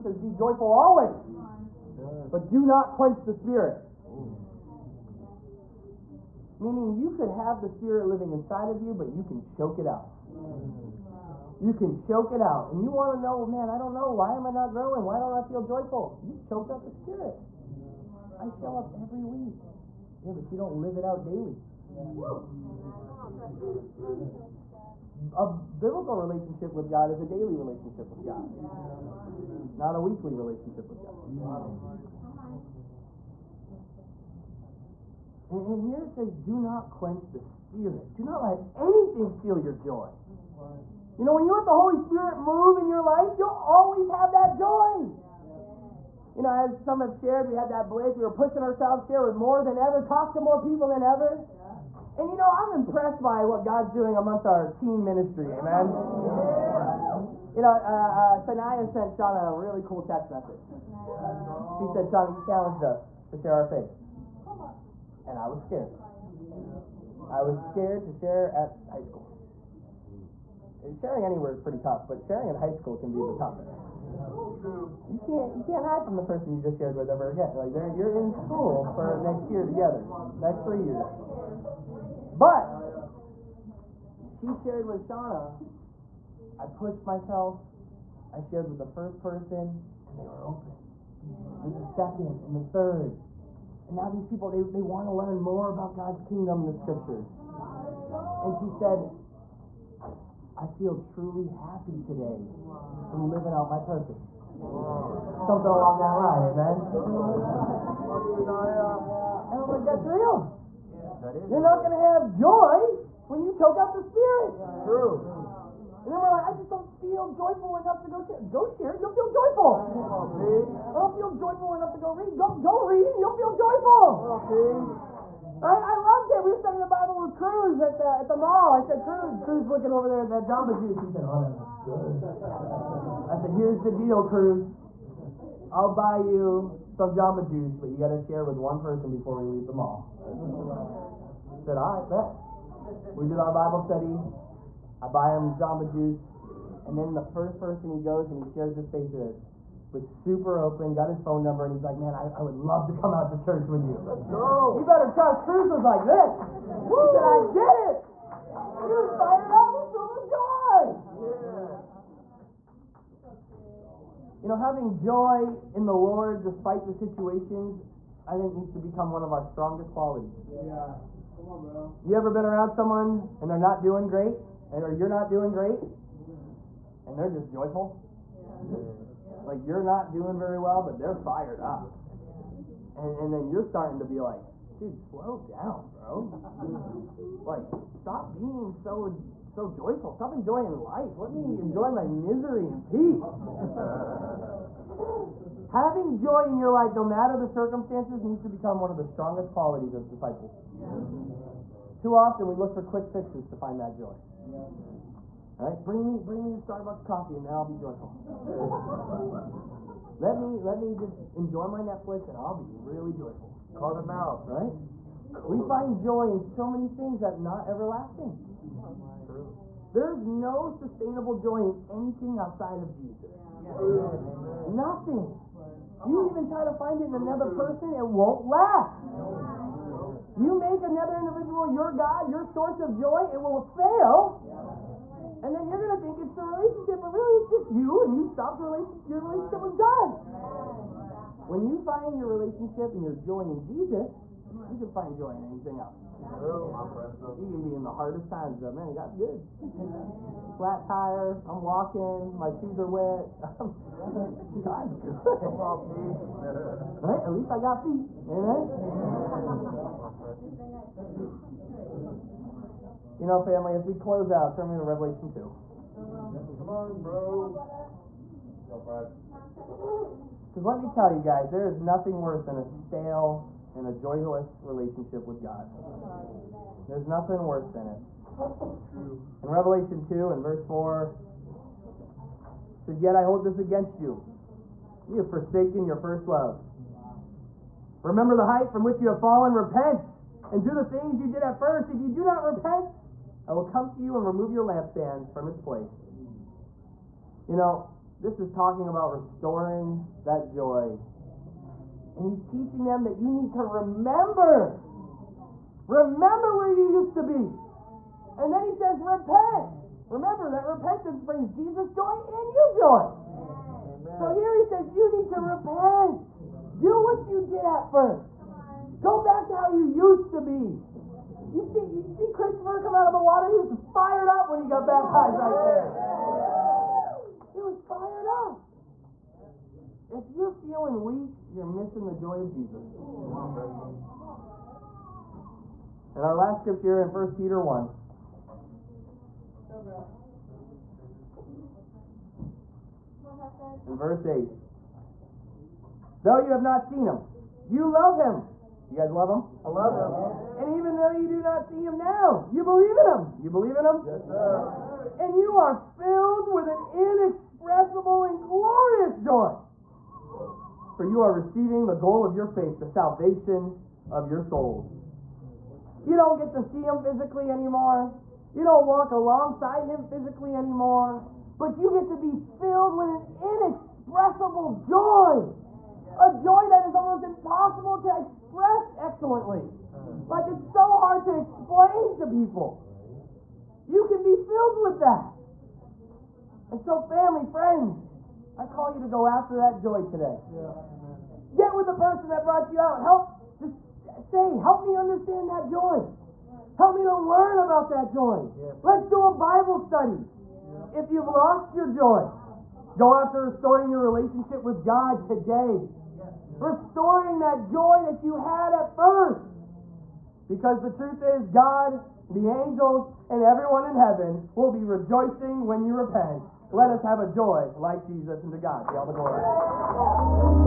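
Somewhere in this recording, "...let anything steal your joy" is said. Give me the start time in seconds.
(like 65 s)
38 s.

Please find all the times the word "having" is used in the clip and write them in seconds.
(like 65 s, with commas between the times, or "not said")
164 s, 195 s.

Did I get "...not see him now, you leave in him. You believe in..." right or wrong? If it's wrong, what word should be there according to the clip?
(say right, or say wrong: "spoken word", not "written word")
wrong: "believe", not "leave".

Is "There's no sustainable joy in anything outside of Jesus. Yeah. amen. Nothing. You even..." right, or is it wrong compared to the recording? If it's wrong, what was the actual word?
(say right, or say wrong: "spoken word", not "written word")
right.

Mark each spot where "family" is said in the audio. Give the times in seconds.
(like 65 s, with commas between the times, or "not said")
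263 s, 387 s.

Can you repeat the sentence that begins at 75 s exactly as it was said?
You can't you can't hide from the person you just shared with ever again.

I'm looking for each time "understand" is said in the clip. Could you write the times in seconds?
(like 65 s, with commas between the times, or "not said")
394 s.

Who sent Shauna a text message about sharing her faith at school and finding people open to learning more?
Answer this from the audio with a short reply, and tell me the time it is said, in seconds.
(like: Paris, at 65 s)
Sanaya, at 58 s.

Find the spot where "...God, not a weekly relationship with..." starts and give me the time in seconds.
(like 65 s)
28 s.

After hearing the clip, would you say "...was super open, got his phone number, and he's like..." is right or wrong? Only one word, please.
right.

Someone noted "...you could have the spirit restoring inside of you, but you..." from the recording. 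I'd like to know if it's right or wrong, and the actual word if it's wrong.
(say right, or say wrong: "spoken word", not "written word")
wrong: "living", not "restoring".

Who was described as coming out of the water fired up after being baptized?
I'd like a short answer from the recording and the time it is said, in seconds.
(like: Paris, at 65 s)
Christopher, at 322 s.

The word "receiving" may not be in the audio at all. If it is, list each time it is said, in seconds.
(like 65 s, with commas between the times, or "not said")
361 s.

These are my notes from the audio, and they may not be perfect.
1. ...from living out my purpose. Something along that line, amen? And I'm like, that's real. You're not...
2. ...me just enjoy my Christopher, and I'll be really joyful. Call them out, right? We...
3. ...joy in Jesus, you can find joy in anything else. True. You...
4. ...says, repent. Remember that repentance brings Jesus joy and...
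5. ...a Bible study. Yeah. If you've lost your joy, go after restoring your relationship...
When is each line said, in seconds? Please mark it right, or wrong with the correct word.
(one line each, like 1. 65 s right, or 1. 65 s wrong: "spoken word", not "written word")
1. 103 s right
2. 210 s wrong: "Netflix", not "Christopher"
3. 243 s right
4. 308 s right
5. 399 s right.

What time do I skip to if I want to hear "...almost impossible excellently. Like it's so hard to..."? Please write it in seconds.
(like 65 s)
376 s.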